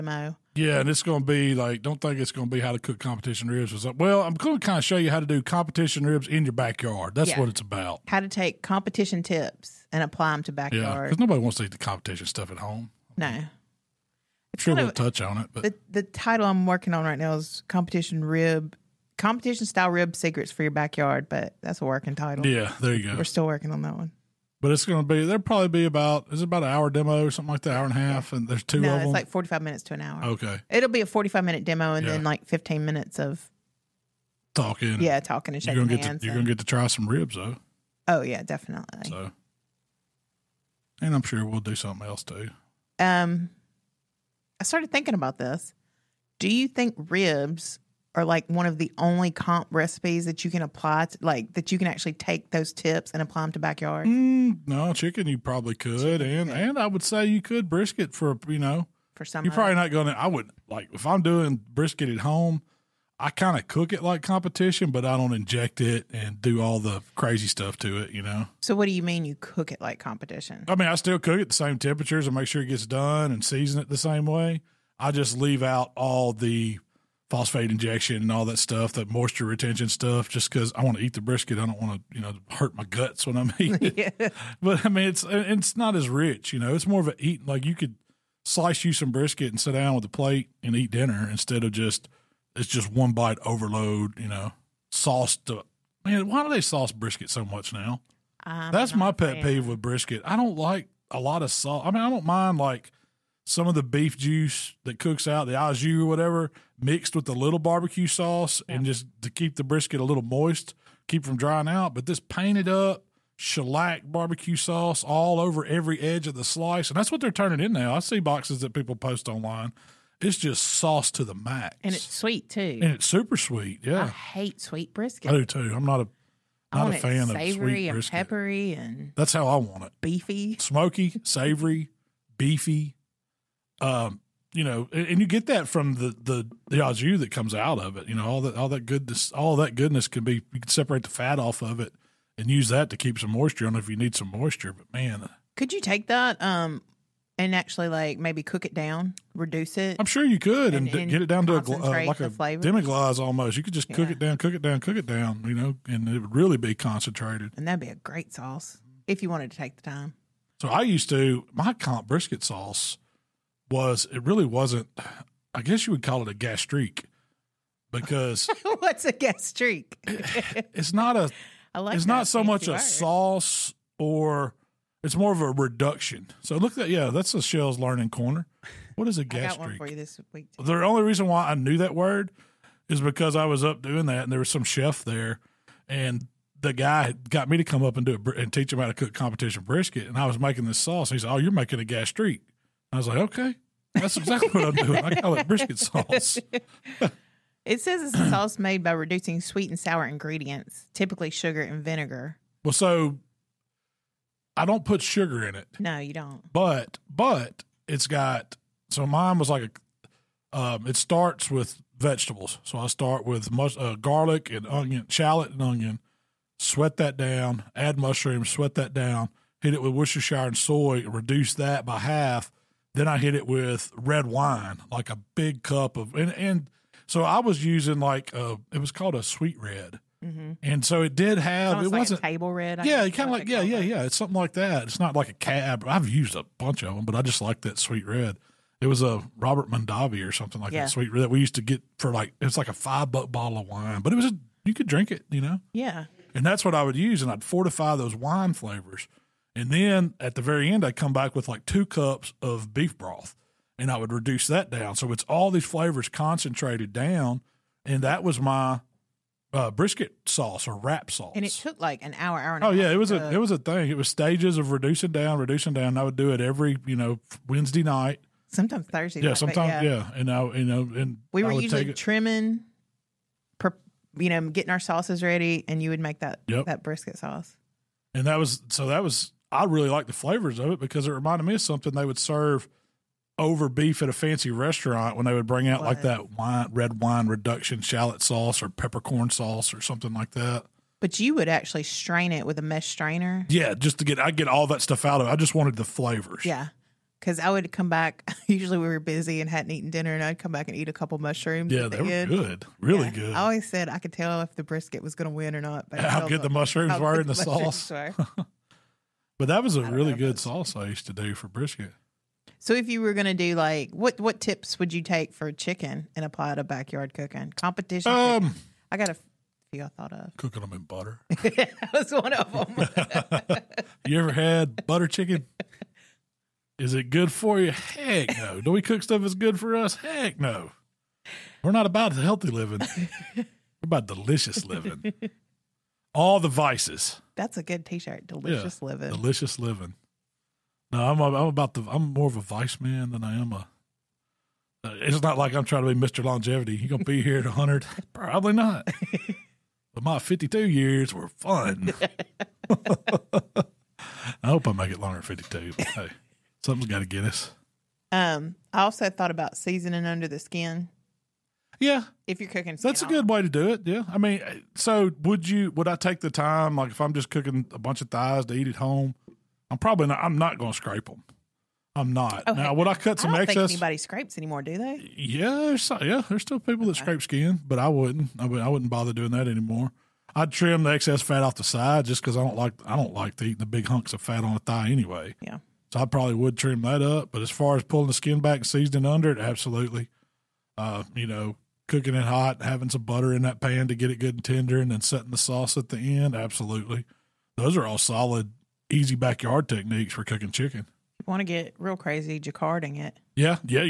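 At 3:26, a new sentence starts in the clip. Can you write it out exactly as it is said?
But but it's got so mine was like a um, it starts with vegetables.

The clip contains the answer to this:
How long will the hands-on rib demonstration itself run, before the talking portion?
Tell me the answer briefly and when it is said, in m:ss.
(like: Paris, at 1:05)
45 minutes, at 0:31.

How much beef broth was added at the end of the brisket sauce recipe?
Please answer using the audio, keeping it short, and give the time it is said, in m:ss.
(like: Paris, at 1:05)
2 cups, at 4:11.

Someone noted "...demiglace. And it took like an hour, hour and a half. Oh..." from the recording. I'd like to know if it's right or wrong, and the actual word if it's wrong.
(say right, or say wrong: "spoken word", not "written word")
wrong: "sauce", not "demiglace".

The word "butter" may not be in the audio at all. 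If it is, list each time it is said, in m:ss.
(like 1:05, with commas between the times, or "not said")
5:20, 5:24, 6:33.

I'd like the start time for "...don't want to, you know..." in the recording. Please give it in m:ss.
1:21.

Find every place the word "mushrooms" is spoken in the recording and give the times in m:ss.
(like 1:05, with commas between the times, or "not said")
3:37, 5:01, 5:06.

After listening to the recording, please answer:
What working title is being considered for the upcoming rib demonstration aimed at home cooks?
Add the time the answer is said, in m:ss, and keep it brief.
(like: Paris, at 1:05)
Competition style rib secrets for your backyard, at 0:19.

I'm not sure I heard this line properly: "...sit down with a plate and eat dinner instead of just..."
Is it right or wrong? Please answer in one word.
right.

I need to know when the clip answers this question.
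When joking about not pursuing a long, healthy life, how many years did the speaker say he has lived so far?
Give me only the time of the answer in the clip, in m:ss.
5:50.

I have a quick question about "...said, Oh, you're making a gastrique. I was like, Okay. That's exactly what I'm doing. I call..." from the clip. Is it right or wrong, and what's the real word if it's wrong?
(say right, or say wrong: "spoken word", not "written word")
right.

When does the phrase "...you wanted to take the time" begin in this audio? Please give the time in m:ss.
2:39.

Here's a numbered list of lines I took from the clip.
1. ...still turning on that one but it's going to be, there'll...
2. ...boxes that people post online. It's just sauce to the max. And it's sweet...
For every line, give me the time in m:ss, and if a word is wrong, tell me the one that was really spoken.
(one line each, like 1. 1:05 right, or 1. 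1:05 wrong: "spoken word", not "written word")
1. 0:23 wrong: "working", not "turning"
2. 1:58 right.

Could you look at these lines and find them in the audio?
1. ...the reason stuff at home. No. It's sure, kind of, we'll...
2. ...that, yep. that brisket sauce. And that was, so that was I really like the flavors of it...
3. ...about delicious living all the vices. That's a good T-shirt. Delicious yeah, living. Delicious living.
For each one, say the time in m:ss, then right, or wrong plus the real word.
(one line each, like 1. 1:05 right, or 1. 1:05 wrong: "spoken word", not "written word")
1. 0:11 wrong: "competition", not "reason"
2. 4:36 right
3. 5:33 right.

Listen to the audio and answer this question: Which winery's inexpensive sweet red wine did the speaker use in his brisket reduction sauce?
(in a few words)
Robert Mondavi.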